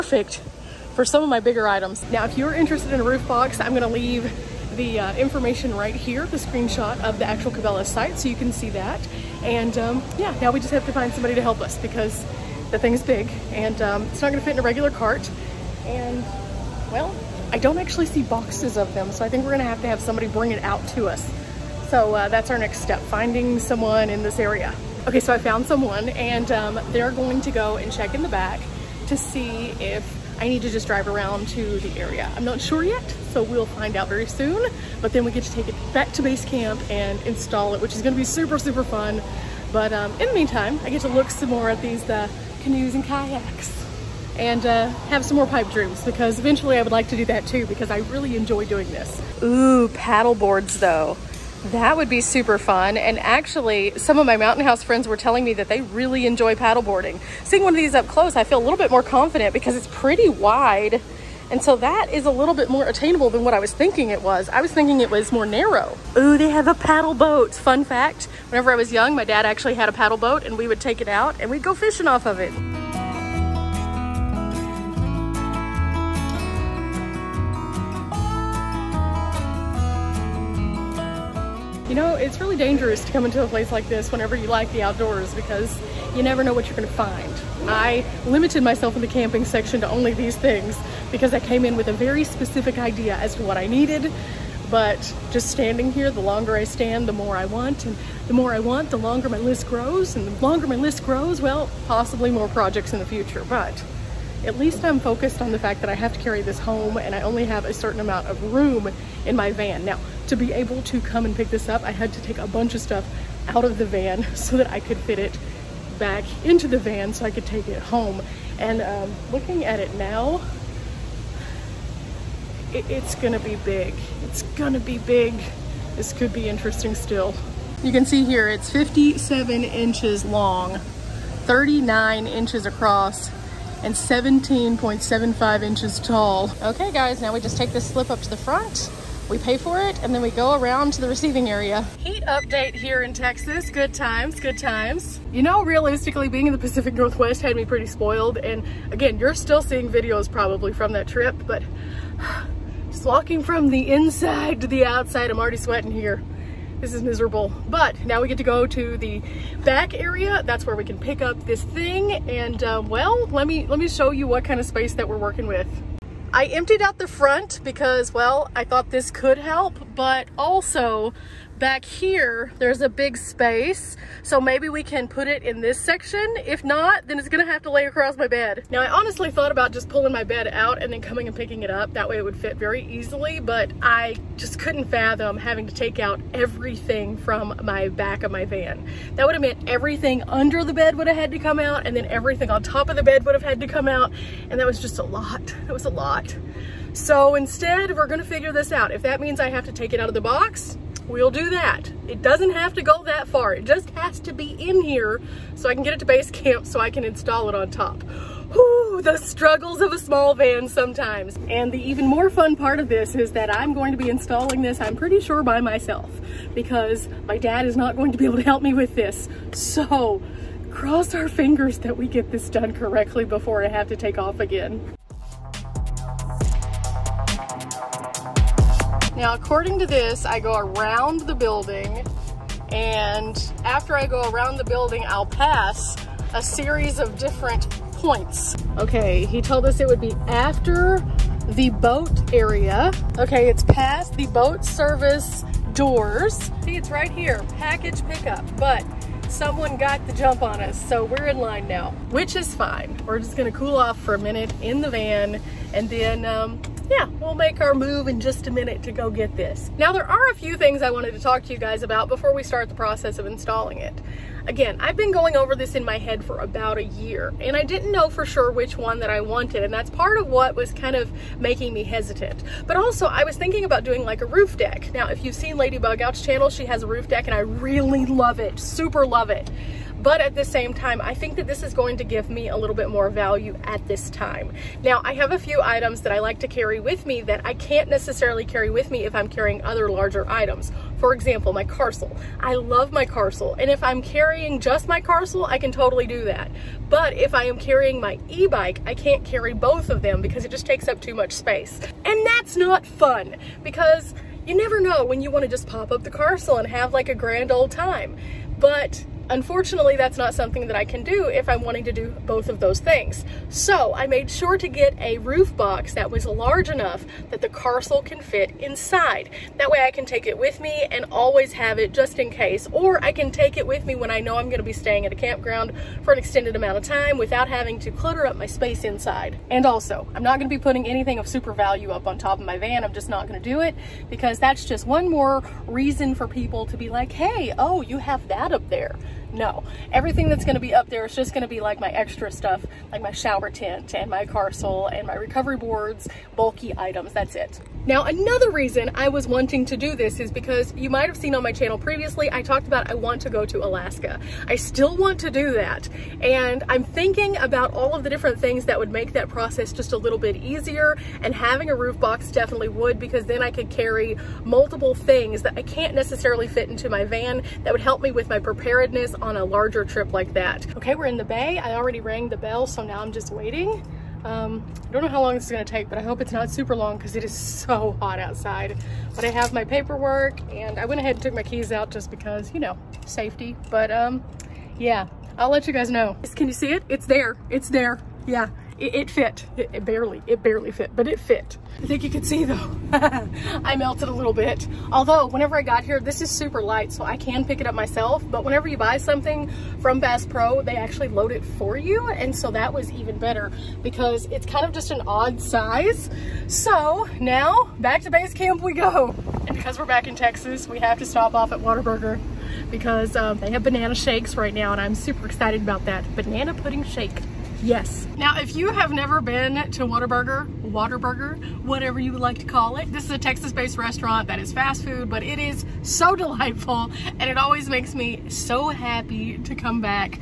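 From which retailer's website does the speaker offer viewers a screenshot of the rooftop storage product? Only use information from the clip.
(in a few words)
Cabela's.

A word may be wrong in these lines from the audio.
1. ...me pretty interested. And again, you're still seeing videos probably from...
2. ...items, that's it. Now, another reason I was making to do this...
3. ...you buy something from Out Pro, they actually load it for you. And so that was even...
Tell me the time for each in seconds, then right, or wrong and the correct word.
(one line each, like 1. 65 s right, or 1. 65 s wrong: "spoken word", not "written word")
1. 147 s wrong: "spoiled", not "interested"
2. 346 s wrong: "wanting", not "making"
3. 398 s wrong: "Bass", not "Out".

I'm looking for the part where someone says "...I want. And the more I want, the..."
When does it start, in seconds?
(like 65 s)
97 s.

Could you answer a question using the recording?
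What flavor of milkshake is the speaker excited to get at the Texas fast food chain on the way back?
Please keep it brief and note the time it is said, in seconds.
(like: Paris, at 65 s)
Banana pudding, at 416 s.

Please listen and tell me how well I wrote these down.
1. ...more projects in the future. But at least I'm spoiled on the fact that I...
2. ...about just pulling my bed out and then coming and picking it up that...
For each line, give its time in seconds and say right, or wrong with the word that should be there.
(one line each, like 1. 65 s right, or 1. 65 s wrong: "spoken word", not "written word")
1. 102 s wrong: "focused", not "spoiled"
2. 179 s right.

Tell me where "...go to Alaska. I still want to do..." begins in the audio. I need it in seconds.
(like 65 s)
353 s.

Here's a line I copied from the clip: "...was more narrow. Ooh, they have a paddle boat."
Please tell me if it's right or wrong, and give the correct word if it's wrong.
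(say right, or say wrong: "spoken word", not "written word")
right.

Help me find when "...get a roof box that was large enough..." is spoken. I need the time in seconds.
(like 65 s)
314 s.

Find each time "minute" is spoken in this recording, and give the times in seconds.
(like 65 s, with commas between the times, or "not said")
254 s, 258 s.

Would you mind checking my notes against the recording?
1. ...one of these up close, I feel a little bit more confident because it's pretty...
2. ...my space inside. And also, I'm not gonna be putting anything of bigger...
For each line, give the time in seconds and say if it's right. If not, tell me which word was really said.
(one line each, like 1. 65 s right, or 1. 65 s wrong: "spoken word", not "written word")
1. 57 s right
2. 328 s wrong: "super", not "bigger".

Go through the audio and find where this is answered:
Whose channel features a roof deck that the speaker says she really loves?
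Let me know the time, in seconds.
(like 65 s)
275 s.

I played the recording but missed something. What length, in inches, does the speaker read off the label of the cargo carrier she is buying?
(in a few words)
57 inches.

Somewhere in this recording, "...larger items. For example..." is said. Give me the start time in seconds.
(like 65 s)
289 s.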